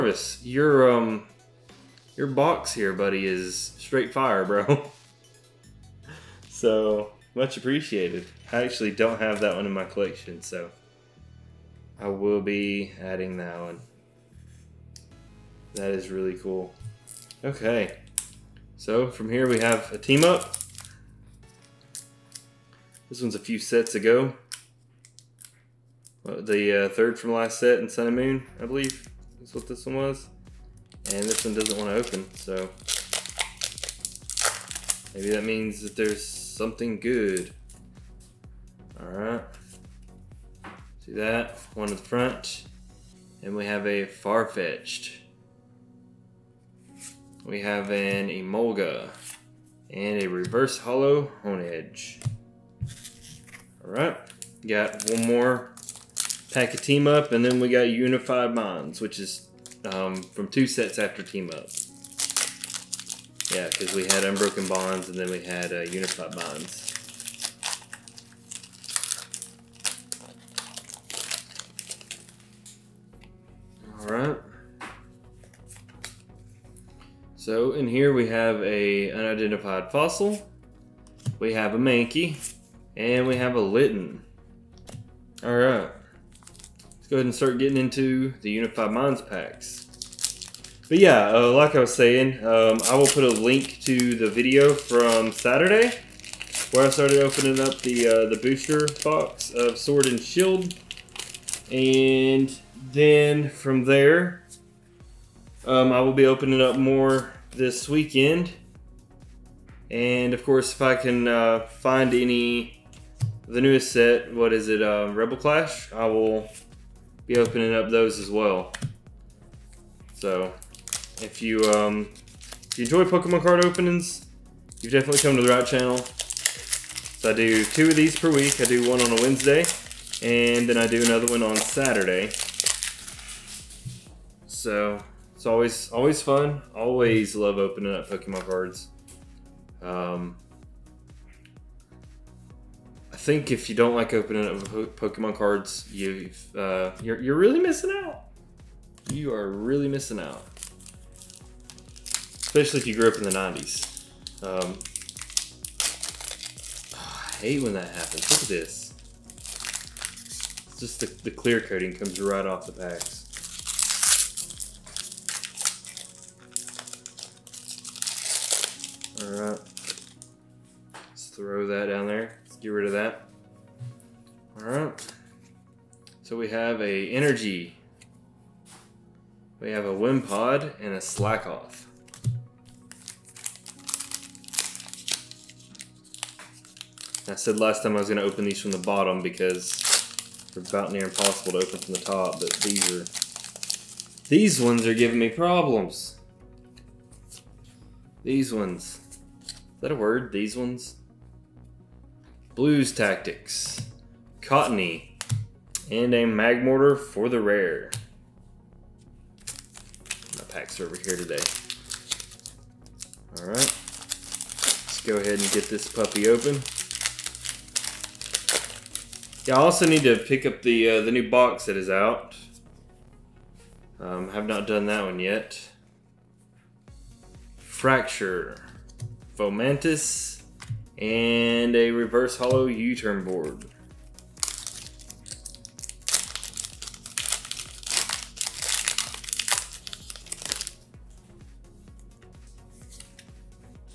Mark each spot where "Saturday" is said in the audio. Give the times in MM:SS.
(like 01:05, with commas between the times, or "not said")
01:35, 02:11.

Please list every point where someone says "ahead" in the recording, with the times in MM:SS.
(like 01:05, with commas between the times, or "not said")
01:27, 03:35.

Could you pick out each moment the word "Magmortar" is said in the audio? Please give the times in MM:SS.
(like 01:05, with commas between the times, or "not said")
03:26.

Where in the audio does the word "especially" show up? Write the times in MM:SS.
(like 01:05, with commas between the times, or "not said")
02:32.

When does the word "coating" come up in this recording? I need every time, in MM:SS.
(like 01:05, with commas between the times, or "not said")
02:41.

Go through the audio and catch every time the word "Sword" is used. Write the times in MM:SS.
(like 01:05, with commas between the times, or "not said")
01:39.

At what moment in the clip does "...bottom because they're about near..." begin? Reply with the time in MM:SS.
03:08.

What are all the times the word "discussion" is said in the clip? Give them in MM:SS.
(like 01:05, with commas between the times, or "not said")
not said.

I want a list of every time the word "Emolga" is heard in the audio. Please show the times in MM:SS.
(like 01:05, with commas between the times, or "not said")
00:48.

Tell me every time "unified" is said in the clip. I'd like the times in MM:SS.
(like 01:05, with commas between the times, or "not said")
00:57, 01:05, 01:28.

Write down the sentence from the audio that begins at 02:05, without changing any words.
So I do two of these per week.